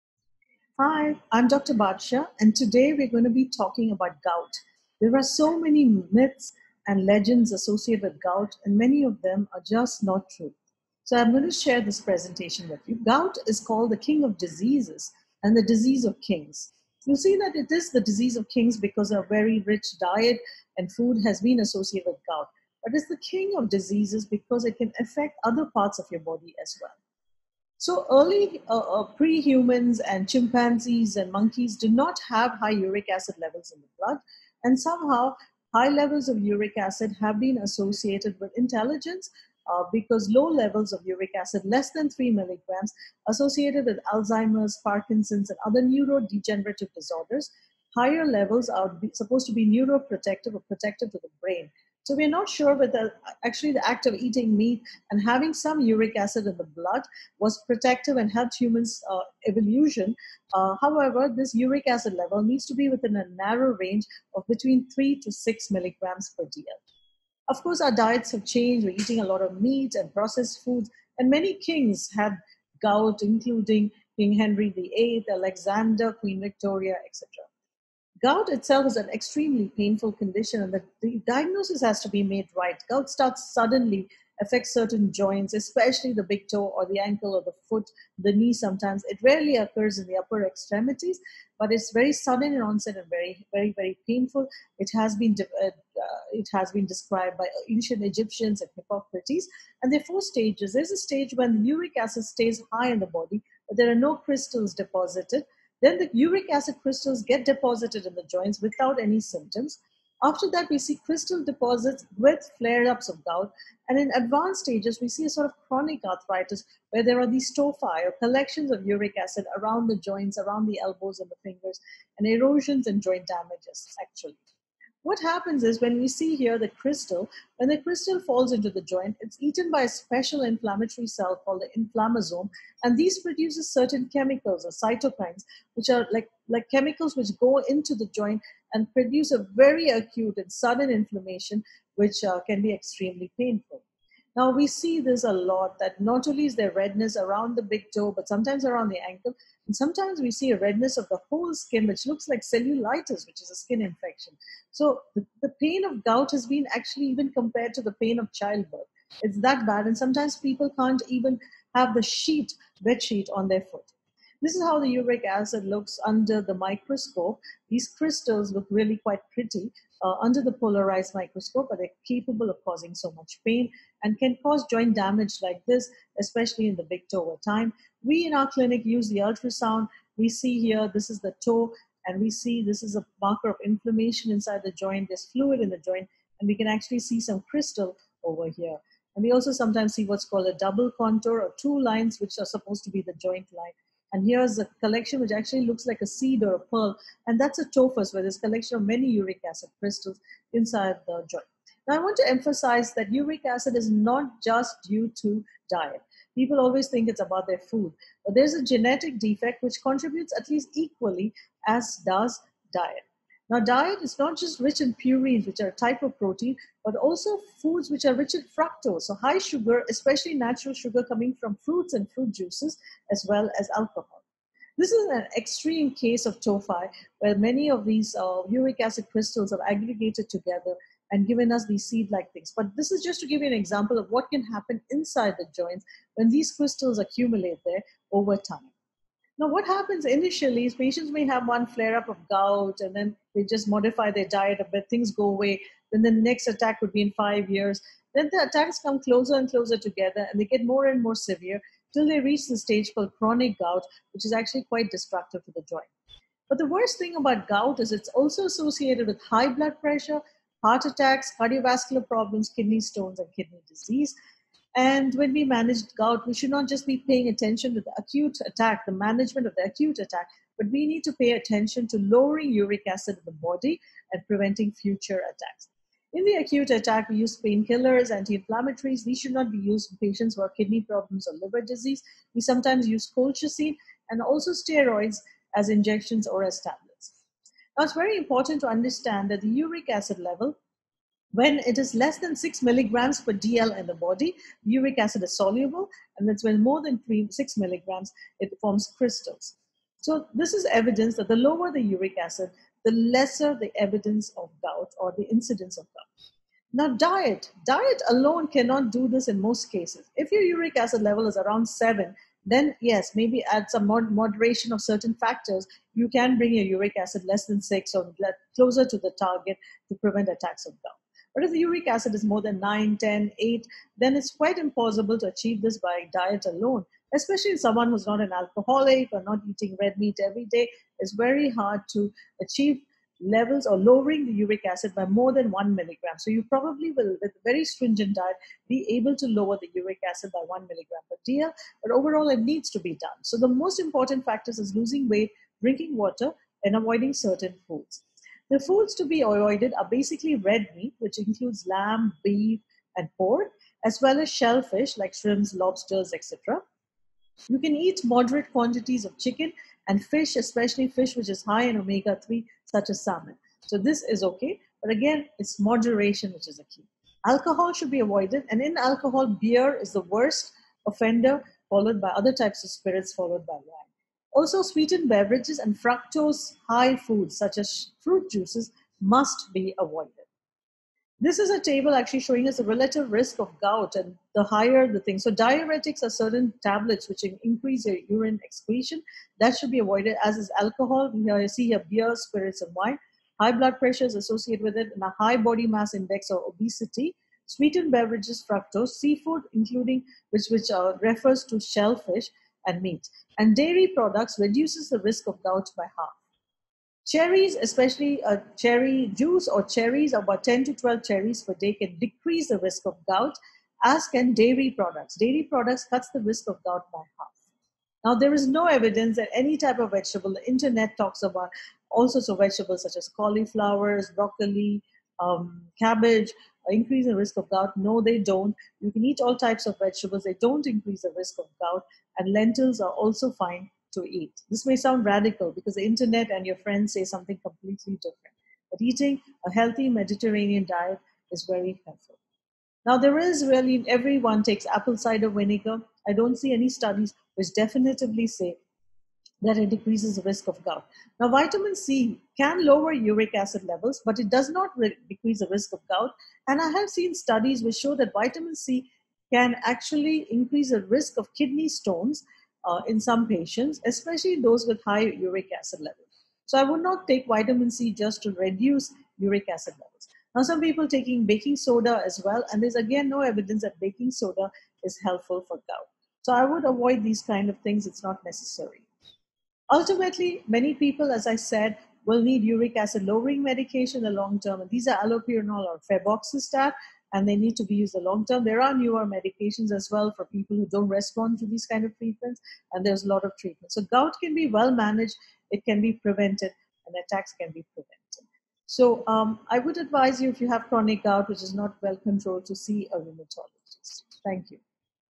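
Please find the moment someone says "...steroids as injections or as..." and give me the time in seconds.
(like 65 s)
284 s.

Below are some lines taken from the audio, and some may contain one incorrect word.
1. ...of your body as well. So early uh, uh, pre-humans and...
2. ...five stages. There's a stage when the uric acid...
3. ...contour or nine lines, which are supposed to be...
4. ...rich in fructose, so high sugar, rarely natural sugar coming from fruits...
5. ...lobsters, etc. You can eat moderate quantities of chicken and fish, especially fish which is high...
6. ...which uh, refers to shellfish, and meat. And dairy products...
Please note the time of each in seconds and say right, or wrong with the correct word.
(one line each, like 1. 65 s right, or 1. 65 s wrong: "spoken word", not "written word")
1. 25 s right
2. 100 s wrong: "four", not "five"
3. 190 s wrong: "two", not "nine"
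4. 218 s wrong: "especially", not "rarely"
5. 355 s right
6. 400 s right.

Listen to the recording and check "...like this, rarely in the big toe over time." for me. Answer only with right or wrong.
wrong.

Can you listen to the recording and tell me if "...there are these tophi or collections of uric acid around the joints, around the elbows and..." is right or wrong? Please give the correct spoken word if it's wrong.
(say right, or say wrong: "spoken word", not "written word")
right.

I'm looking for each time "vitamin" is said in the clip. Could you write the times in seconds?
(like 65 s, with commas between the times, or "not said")
451 s, 458 s, 467 s.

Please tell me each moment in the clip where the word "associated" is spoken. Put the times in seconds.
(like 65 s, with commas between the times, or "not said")
7 s, 21 s, 37 s, 43 s, 258 s, 394 s.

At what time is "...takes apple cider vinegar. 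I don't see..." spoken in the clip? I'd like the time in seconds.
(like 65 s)
444 s.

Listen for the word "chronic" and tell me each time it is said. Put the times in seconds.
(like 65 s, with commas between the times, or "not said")
115 s, 253 s, 500 s.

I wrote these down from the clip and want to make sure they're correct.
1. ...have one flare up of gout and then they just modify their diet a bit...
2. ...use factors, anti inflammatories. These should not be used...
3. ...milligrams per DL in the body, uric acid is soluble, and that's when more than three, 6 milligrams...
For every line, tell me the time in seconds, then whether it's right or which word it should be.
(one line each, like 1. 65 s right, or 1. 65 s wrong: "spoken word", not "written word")
1. 241 s right
2. 277 s wrong: "painkillers", not "factors"
3. 292 s right.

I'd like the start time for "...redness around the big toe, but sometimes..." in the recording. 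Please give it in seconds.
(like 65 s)
146 s.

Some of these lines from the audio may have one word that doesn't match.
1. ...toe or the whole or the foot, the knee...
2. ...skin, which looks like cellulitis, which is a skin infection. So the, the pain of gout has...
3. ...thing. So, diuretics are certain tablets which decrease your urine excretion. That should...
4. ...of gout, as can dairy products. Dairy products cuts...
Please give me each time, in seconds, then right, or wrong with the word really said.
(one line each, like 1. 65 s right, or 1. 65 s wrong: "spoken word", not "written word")
1. 86 s wrong: "ankle", not "whole"
2. 151 s right
3. 385 s wrong: "increase", not "decrease"
4. 412 s right.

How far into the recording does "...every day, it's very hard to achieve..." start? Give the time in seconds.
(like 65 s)
330 s.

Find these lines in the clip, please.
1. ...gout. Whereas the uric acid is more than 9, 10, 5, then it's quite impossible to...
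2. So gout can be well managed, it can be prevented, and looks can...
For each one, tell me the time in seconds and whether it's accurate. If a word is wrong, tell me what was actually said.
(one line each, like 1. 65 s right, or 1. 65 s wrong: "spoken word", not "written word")
1. 320 s wrong: "8", not "5"
2. 493 s wrong: "attacks", not "looks".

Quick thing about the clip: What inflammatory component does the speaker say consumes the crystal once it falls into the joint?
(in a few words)
inflammasome.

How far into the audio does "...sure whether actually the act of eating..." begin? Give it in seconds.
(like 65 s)
52 s.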